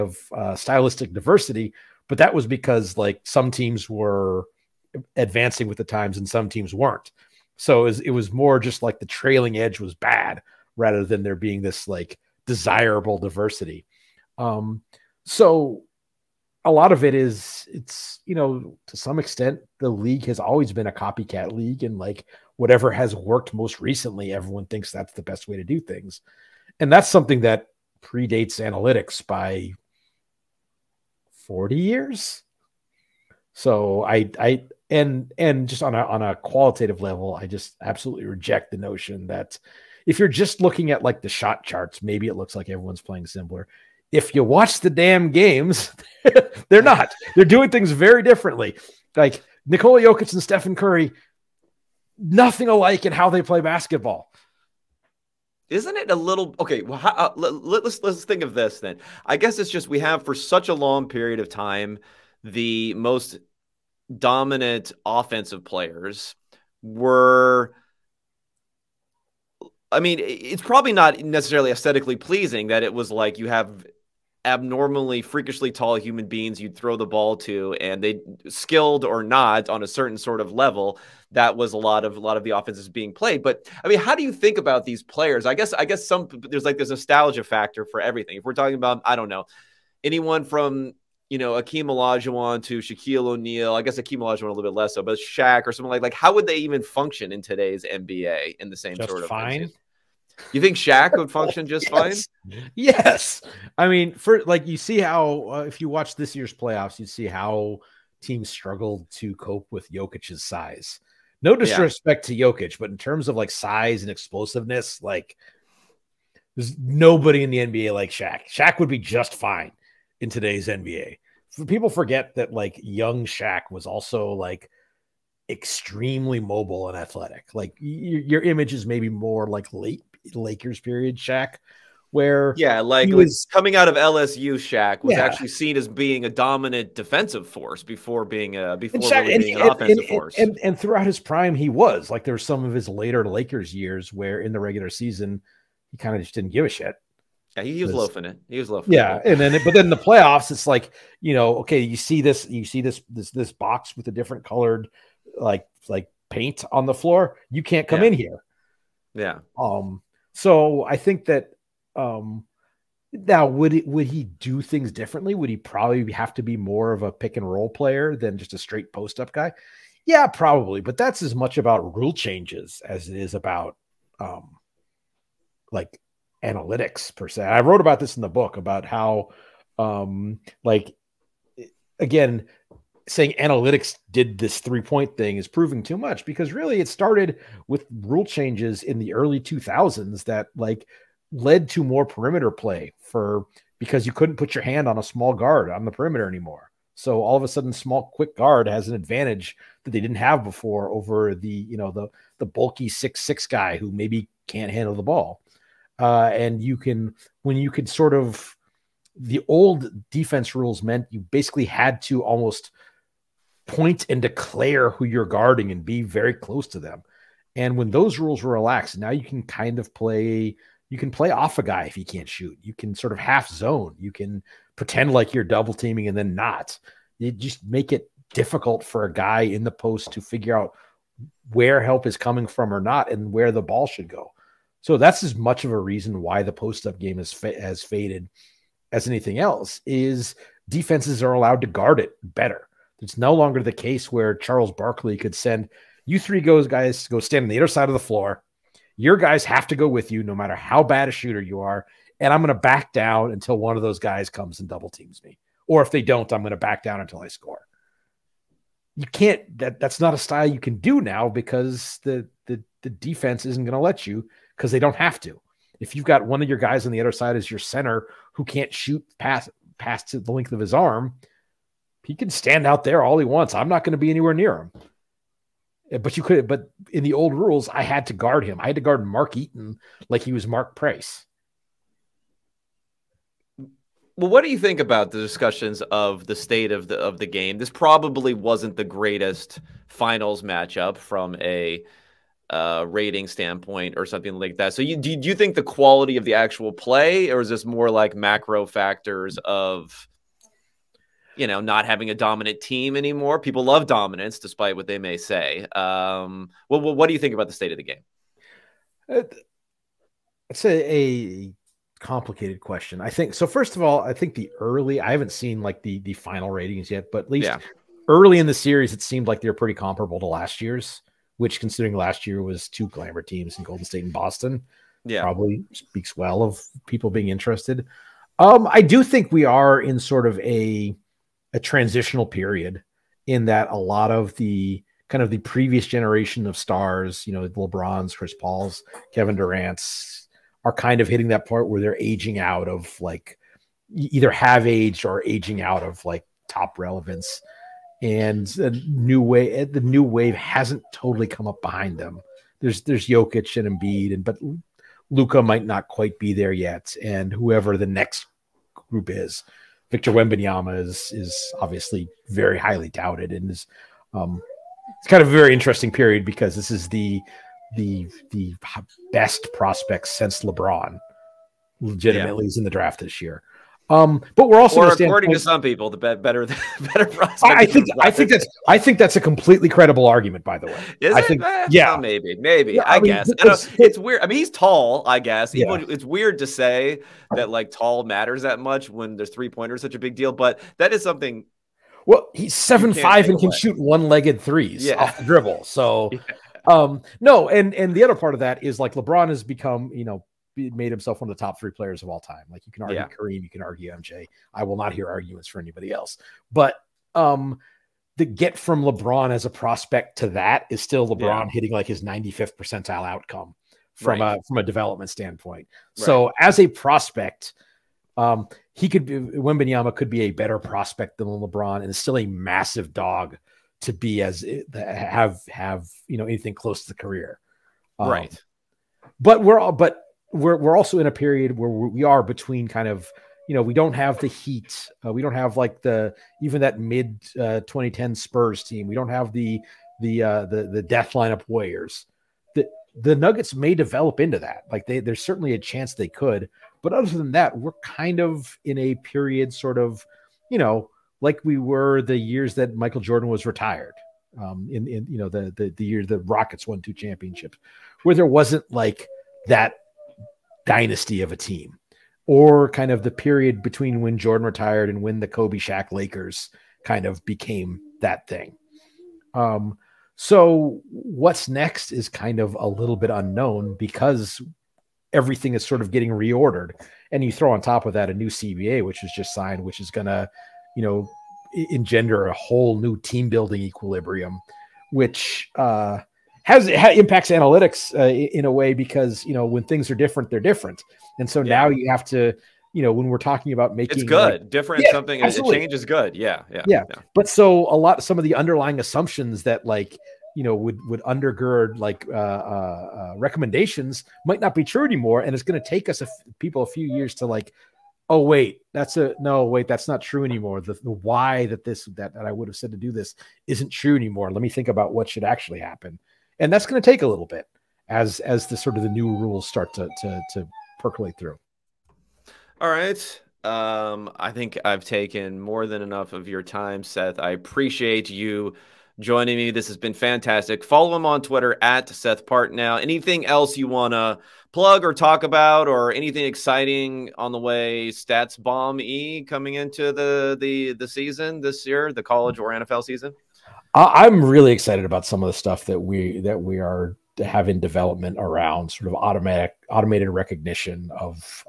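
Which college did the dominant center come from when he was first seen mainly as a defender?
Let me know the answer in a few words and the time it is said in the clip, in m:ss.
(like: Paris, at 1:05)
LSU, at 2:13.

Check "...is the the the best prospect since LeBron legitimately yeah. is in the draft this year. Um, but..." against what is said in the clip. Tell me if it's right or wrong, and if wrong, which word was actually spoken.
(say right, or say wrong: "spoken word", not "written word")
right.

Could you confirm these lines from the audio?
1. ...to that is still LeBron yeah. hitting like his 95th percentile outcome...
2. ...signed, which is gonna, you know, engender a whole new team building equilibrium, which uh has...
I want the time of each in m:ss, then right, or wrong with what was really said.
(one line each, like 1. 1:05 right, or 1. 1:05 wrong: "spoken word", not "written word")
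1. 6:50 right
2. 7:59 right.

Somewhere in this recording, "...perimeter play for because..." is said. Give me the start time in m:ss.
3:12.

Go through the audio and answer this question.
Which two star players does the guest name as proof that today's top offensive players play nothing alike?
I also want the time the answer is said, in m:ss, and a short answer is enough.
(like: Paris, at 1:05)
Nikola Jokic and Stephen Curry, at 0:49.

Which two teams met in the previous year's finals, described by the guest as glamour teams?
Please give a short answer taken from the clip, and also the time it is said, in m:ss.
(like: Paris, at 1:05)
Golden State and Boston, at 5:23.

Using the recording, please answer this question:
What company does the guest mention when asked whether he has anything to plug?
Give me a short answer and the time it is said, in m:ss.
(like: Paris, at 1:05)
StatsBomb, at 8:57.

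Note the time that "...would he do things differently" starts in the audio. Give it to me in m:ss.
2:43.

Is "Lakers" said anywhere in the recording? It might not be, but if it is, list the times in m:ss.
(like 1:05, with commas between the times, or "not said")
2:10, 2:23, 7:45.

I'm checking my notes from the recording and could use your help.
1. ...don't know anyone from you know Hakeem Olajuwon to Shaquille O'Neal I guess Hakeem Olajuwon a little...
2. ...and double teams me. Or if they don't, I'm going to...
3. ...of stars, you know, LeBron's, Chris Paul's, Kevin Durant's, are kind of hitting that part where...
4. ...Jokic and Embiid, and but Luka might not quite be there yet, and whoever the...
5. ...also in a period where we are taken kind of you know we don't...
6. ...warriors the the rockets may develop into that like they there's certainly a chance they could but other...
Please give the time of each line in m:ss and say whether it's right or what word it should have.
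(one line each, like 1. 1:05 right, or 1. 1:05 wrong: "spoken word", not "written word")
1. 1:29 right
2. 4:14 right
3. 5:36 right
4. 5:53 right
5. 7:10 wrong: "between", not "taken"
6. 7:21 wrong: "nuggets", not "rockets".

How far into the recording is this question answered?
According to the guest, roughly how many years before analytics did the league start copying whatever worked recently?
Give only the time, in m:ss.
0:31.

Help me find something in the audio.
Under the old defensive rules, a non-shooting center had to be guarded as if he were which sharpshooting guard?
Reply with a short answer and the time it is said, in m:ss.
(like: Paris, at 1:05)
Mark Price, at 4:40.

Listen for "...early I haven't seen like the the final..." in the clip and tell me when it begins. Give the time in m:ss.
5:14.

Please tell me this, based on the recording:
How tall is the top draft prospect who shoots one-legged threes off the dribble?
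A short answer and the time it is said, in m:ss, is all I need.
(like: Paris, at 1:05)
7 feet 5, at 6:32.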